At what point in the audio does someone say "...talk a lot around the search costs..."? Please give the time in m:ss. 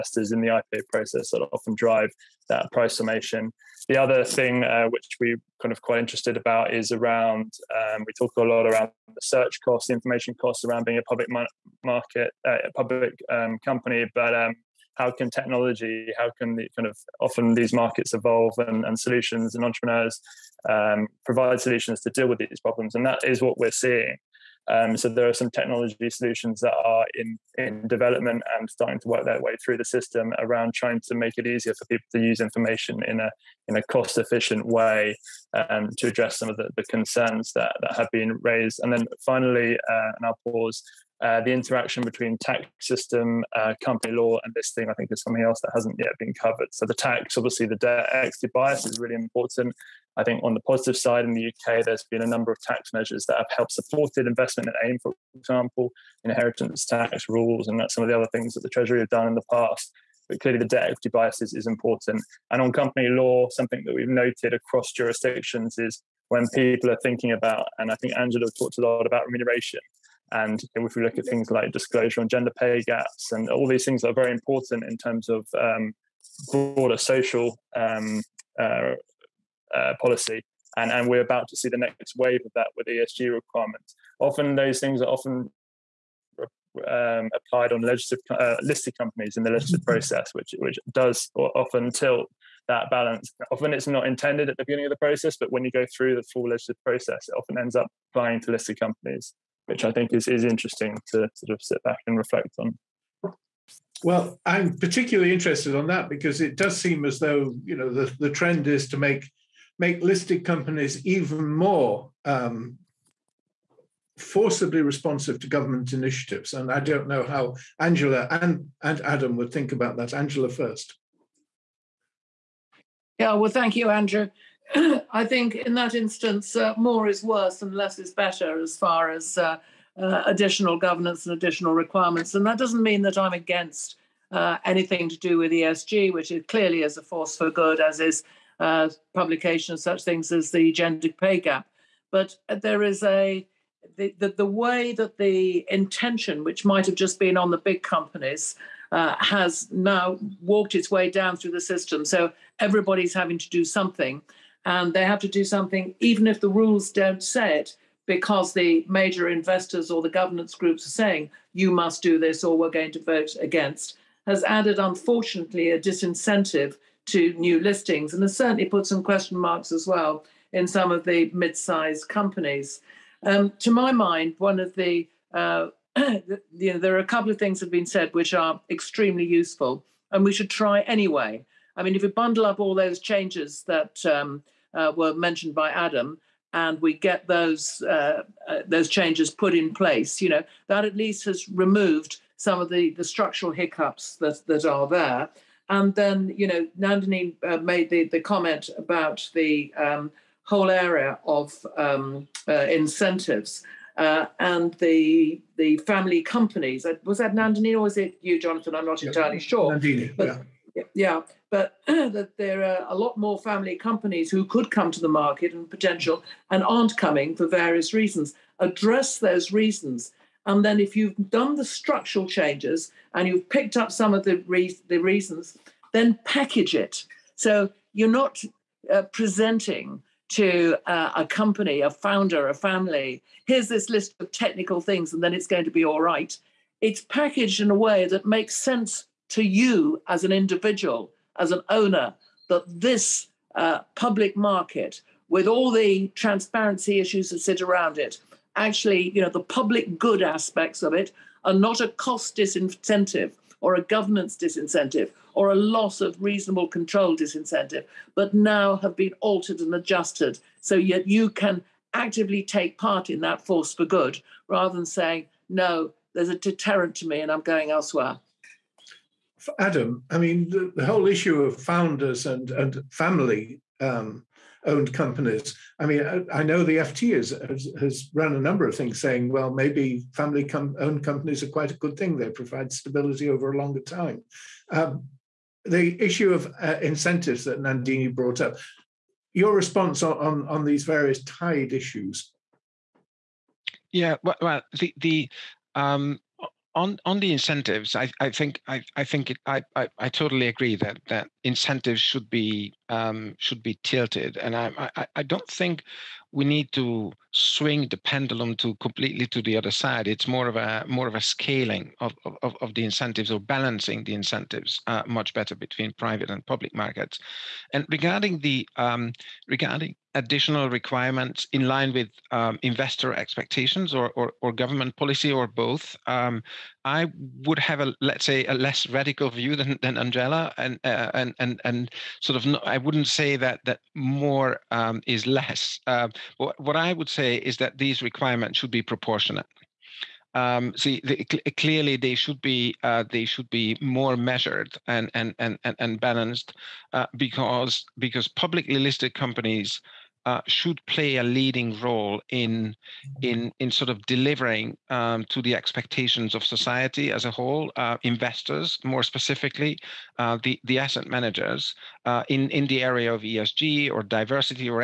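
0:08.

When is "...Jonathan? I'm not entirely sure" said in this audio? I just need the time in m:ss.
3:28.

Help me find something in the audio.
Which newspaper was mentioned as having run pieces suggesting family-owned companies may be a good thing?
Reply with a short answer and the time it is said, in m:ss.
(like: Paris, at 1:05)
FT, at 4:36.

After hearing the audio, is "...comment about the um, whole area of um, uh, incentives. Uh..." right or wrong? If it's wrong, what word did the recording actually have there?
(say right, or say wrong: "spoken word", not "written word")
right.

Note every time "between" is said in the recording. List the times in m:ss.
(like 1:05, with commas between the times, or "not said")
0:42, 5:15.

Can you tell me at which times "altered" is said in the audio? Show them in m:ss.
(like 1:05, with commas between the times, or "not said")
4:19.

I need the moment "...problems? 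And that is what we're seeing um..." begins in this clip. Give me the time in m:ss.
0:22.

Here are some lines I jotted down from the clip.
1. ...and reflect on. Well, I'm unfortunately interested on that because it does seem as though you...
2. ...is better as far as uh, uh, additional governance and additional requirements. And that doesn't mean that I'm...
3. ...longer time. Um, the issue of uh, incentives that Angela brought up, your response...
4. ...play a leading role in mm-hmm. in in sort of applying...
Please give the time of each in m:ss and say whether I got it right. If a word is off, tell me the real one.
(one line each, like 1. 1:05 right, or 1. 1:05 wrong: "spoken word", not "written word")
1. 1:42 wrong: "particularly", not "unfortunately"
2. 2:07 right
3. 4:43 wrong: "Nandini", not "Angela"
4. 5:50 wrong: "delivering", not "applying".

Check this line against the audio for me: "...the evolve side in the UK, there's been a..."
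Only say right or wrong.
wrong.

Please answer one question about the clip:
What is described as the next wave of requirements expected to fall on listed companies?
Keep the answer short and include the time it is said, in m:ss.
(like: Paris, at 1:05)
ESG requirements, at 1:22.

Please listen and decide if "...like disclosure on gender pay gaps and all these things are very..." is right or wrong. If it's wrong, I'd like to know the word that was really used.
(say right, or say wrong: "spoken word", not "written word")
right.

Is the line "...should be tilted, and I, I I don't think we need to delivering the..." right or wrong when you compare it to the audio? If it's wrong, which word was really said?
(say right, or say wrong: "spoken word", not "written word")
wrong: "swing", not "delivering".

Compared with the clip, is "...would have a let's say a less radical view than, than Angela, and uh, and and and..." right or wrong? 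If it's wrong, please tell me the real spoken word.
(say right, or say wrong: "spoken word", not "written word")
right.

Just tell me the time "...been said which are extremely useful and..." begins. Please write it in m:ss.
2:57.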